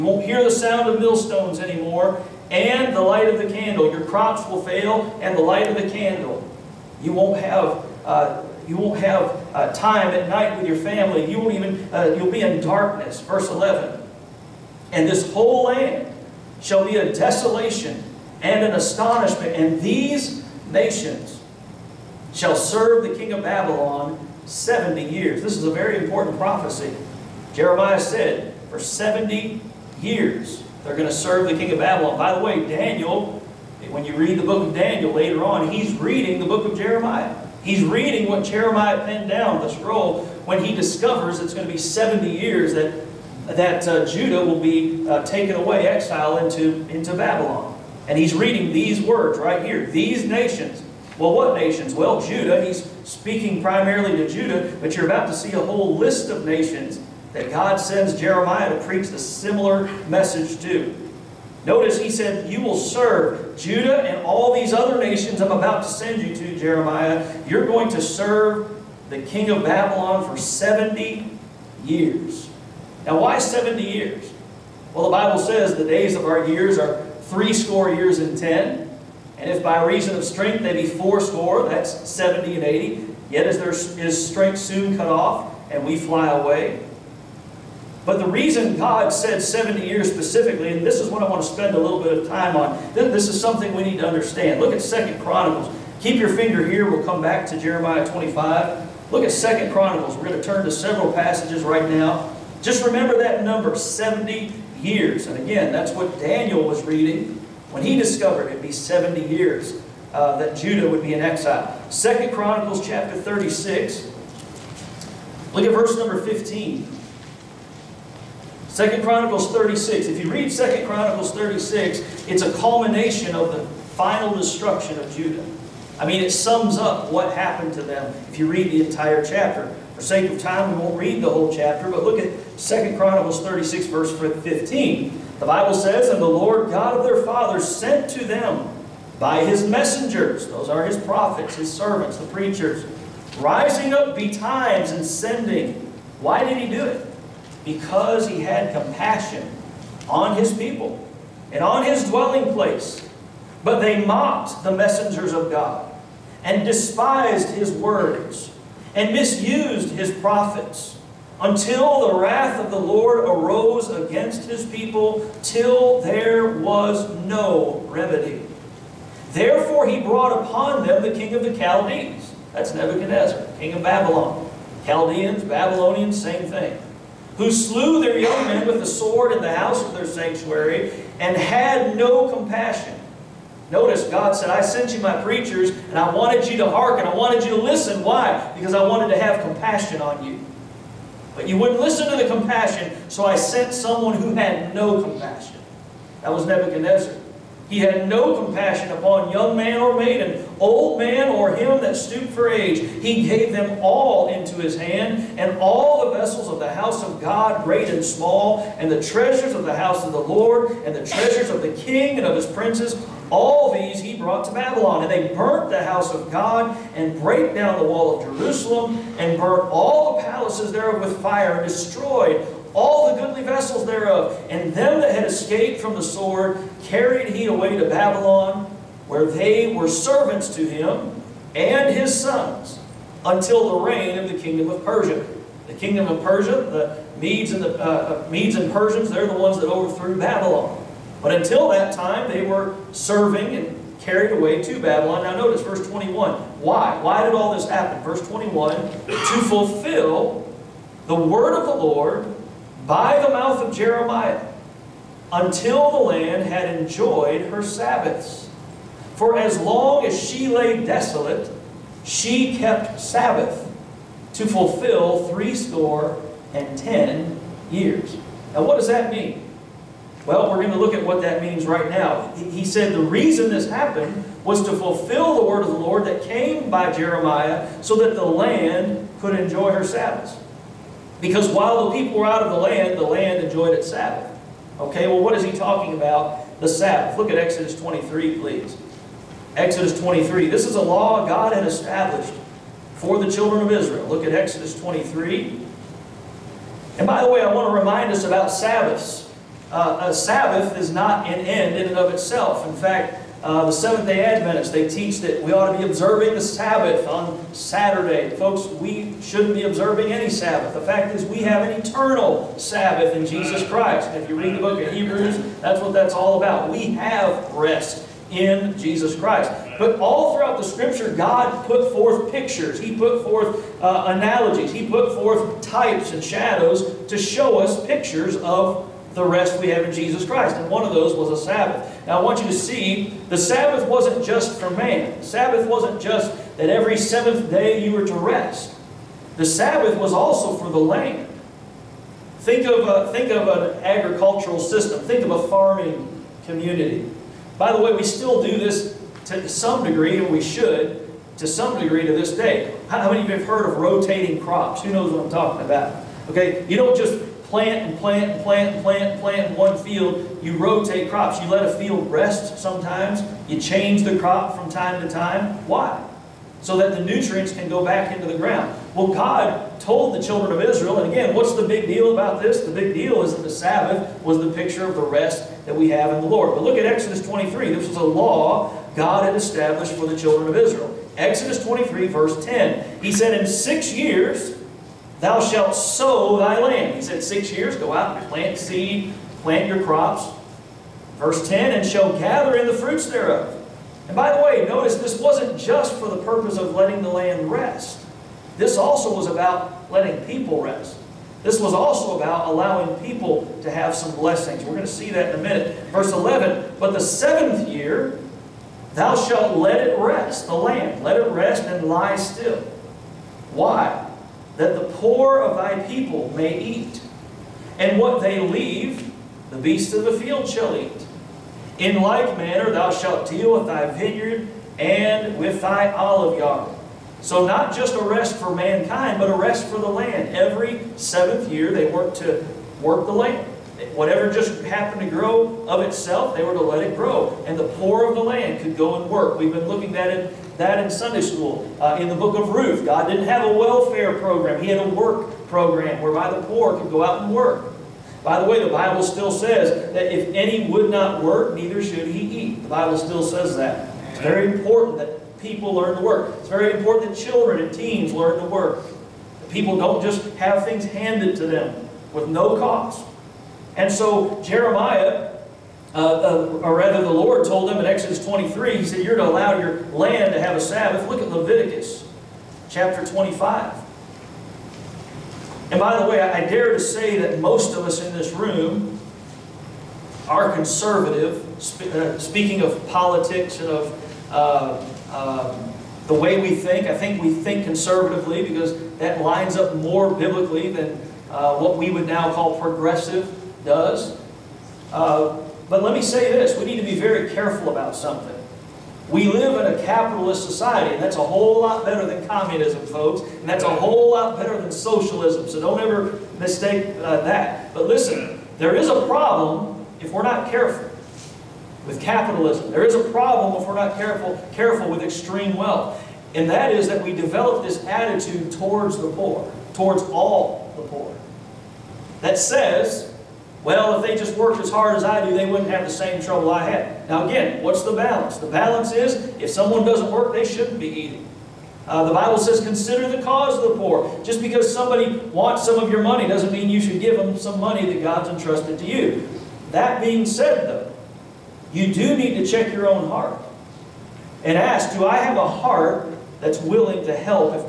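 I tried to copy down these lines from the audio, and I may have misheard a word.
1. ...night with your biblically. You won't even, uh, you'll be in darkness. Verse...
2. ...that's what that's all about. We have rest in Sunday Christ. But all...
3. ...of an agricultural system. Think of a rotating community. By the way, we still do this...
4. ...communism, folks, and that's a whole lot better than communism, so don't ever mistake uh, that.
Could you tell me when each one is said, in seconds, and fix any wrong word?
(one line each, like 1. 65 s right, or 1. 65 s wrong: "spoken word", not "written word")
1. 10 s wrong: "family", not "biblically"
2. 315 s wrong: "Jesus", not "Sunday"
3. 343 s wrong: "farming", not "rotating"
4. 502 s wrong: "socialism", not "communism".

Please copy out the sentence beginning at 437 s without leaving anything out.
And the poor of the land could go and work.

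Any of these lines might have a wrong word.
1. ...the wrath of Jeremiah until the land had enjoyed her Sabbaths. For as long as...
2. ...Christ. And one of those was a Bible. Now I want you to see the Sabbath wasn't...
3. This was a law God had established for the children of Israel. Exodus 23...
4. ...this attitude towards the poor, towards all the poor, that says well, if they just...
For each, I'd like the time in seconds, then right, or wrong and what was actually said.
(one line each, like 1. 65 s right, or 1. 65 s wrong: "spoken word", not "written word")
1. 253 s wrong: "mouth", not "wrath"
2. 330 s wrong: "Sabbath", not "Bible"
3. 377 s right
4. 517 s right.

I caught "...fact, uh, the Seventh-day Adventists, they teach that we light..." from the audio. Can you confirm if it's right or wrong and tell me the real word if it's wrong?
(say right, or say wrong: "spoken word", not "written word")
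wrong: "ought", not "light".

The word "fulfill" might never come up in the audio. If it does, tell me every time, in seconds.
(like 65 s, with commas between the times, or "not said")
249 s, 264 s, 274 s.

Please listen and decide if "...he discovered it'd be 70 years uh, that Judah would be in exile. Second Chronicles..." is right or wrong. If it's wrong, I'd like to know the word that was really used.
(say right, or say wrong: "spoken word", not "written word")
right.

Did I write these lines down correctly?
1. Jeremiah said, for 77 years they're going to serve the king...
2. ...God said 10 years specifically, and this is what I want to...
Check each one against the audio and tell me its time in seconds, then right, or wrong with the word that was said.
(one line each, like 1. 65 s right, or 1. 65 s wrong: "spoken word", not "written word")
1. 27 s wrong: "70", not "77"
2. 88 s wrong: "70", not "10".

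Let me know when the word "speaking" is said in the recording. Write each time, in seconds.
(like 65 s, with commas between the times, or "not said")
53 s, 482 s.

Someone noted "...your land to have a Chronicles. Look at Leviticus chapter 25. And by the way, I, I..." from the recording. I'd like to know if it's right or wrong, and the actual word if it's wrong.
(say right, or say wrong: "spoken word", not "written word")
wrong: "Sabbath", not "Chronicles".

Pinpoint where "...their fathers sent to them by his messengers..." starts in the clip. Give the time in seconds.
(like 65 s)
137 s.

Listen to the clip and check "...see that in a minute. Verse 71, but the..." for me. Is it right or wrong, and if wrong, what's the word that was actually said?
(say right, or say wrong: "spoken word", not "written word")
wrong: "11", not "71".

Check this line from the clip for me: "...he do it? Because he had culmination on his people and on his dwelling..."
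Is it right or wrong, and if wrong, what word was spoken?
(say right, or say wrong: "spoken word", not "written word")
wrong: "compassion", not "culmination".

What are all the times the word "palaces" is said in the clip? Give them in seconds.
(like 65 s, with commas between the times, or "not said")
220 s.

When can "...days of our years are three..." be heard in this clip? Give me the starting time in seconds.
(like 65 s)
75 s.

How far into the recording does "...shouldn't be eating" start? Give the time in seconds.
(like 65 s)
530 s.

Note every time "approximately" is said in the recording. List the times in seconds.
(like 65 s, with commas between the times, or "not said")
not said.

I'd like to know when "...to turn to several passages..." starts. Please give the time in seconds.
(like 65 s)
100 s.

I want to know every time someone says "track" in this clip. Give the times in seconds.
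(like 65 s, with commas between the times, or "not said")
not said.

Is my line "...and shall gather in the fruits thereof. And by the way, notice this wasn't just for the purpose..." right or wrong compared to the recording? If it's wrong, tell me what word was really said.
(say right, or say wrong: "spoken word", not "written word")
right.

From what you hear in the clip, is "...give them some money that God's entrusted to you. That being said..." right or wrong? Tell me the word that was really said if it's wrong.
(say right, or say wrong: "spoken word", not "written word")
right.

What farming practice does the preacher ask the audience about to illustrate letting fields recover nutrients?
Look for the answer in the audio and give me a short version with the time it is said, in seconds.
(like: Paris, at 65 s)
Rotating crops, at 353 s.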